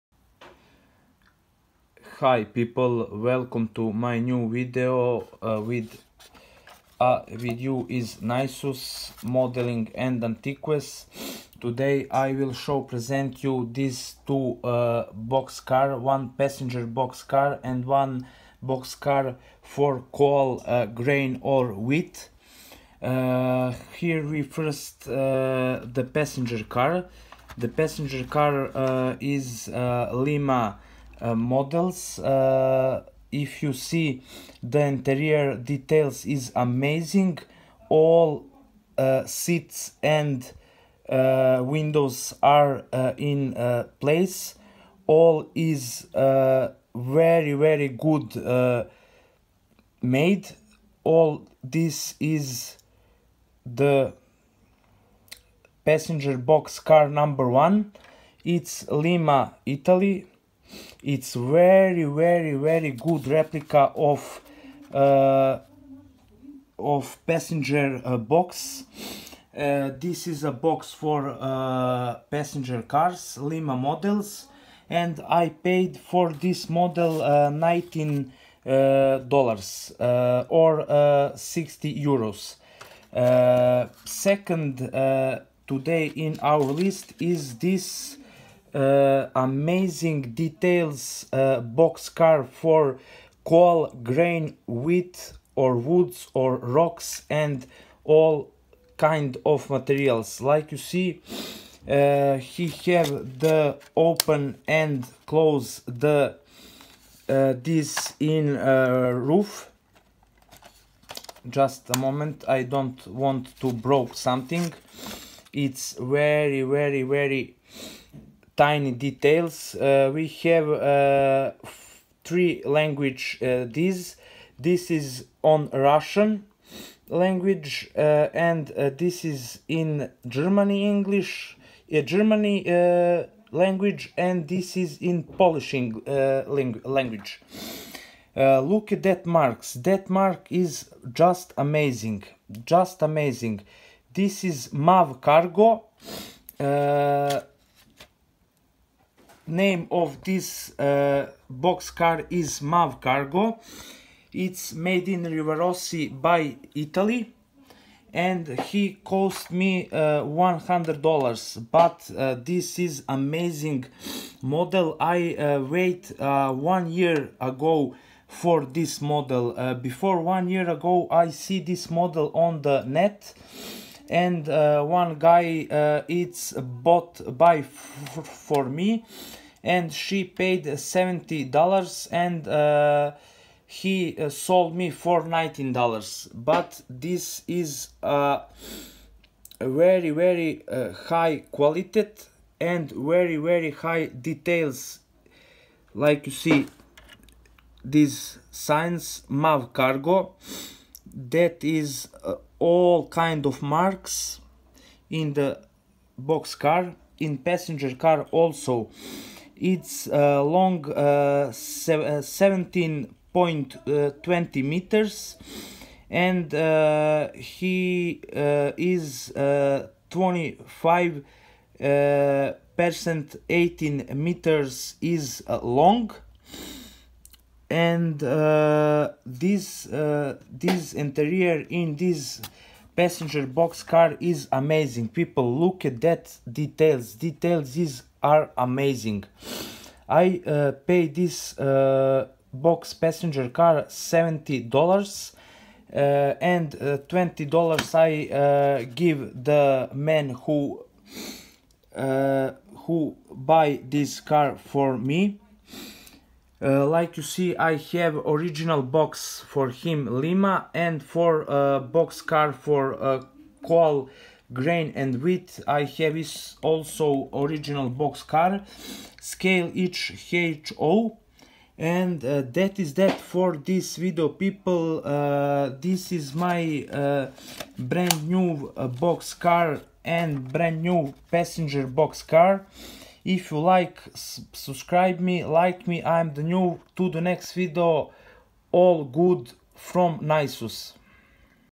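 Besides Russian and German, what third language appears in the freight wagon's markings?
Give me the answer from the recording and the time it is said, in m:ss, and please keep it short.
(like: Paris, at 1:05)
Polish, at 2:15.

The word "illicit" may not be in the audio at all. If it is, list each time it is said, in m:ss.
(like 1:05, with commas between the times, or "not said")
not said.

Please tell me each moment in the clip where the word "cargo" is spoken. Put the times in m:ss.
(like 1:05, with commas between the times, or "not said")
2:25, 2:33, 3:19.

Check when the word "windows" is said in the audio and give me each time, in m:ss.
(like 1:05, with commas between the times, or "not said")
0:41.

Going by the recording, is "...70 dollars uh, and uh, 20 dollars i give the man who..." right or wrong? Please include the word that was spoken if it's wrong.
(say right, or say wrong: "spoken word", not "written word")
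right.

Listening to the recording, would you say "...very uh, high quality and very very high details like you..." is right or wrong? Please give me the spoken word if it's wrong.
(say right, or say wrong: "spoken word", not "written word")
right.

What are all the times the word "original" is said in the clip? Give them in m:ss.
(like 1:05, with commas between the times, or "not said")
4:18, 4:27.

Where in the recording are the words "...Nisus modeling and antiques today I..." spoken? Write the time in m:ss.
0:08.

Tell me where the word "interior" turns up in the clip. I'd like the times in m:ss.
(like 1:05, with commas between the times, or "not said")
0:34, 3:50.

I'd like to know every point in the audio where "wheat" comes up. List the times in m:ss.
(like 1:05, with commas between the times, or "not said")
0:21, 1:34, 4:25.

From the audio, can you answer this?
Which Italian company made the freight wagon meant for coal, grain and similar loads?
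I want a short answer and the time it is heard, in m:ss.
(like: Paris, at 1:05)
Rivarossi, at 2:35.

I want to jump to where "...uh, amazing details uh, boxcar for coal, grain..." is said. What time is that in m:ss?
1:28.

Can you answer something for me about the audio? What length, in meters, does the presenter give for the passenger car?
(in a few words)
17.20 meters.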